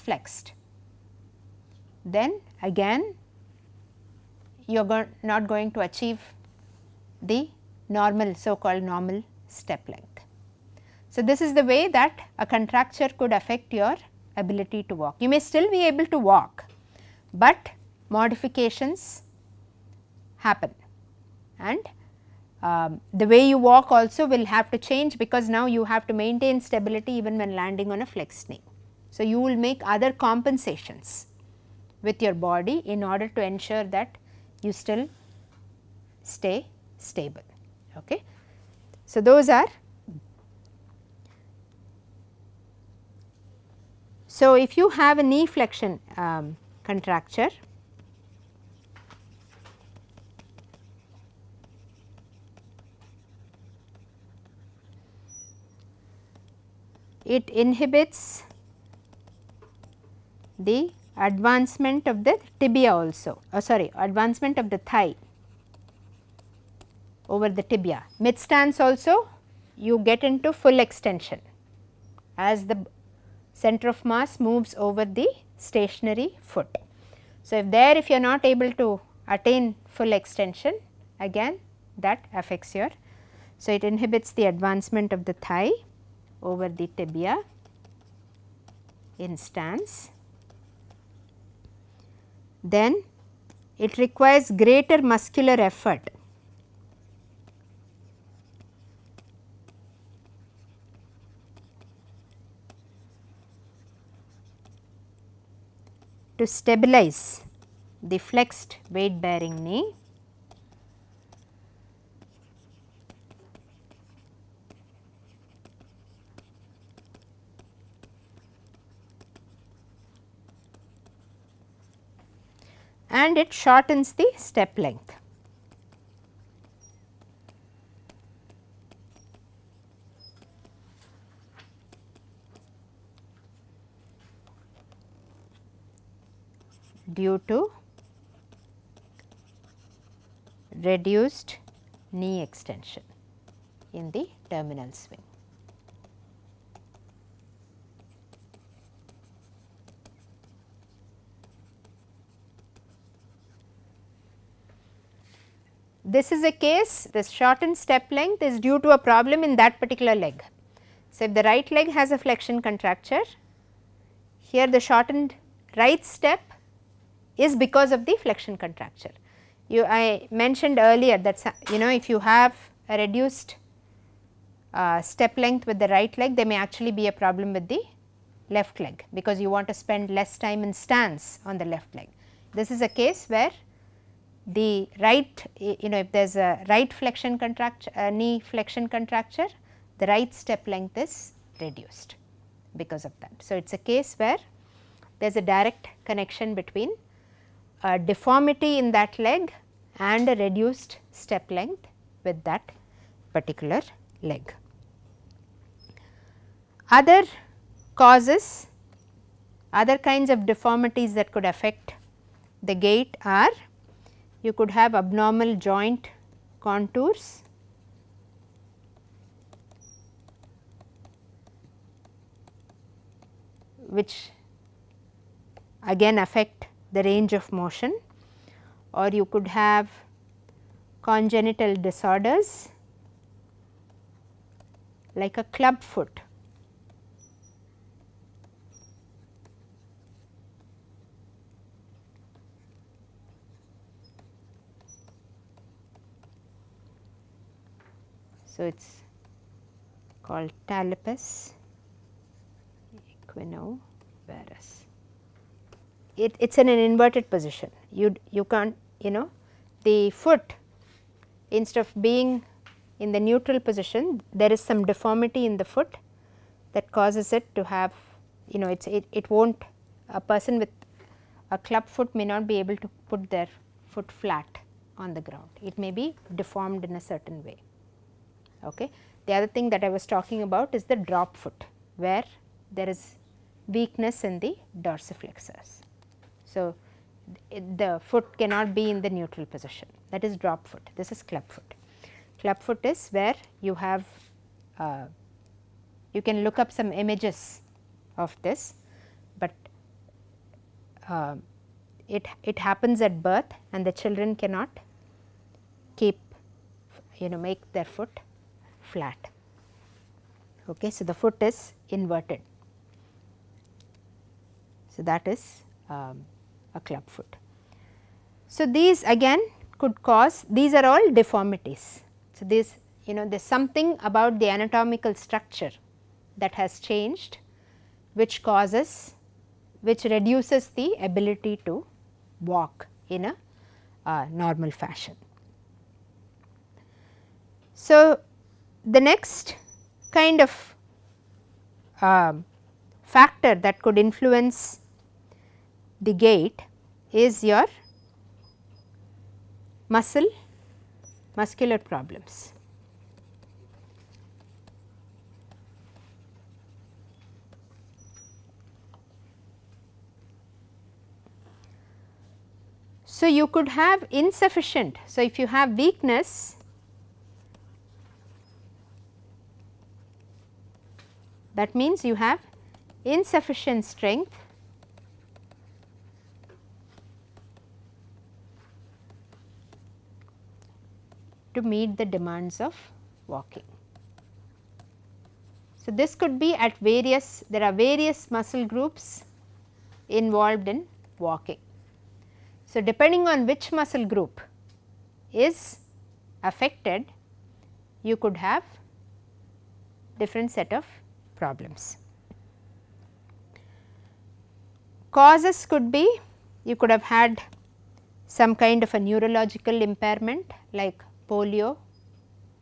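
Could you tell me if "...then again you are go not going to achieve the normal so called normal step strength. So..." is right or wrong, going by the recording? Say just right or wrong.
wrong.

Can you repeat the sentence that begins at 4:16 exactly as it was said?
It, it is in an inverted position.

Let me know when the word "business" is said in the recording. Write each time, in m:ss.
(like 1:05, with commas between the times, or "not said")
not said.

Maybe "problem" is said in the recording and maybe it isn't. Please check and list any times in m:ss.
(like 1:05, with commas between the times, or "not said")
2:39, 2:57, 5:51, 6:41.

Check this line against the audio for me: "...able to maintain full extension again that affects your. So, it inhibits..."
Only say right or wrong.
wrong.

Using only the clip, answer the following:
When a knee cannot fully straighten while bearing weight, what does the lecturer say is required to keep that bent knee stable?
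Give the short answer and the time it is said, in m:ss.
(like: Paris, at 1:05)
Greater muscular effort, at 1:34.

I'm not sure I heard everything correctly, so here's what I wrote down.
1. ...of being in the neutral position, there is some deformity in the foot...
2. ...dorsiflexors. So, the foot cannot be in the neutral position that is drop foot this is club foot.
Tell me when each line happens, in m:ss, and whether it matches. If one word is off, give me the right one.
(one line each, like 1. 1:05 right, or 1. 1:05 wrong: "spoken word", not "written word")
1. 4:21 right
2. 4:44 right.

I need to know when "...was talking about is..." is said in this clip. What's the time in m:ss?
4:39.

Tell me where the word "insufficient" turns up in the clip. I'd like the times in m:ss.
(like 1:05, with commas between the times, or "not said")
6:04, 6:13.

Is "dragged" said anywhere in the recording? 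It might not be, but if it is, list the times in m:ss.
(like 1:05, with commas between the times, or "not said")
not said.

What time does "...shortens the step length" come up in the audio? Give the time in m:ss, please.
2:03.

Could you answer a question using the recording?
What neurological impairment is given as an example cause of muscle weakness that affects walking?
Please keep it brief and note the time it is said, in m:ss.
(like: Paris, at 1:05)
Polio, at 6:51.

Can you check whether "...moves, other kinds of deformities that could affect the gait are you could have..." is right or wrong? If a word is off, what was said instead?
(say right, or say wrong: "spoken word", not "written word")
wrong: "causes", not "moves".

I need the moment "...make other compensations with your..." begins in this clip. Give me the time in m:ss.
0:29.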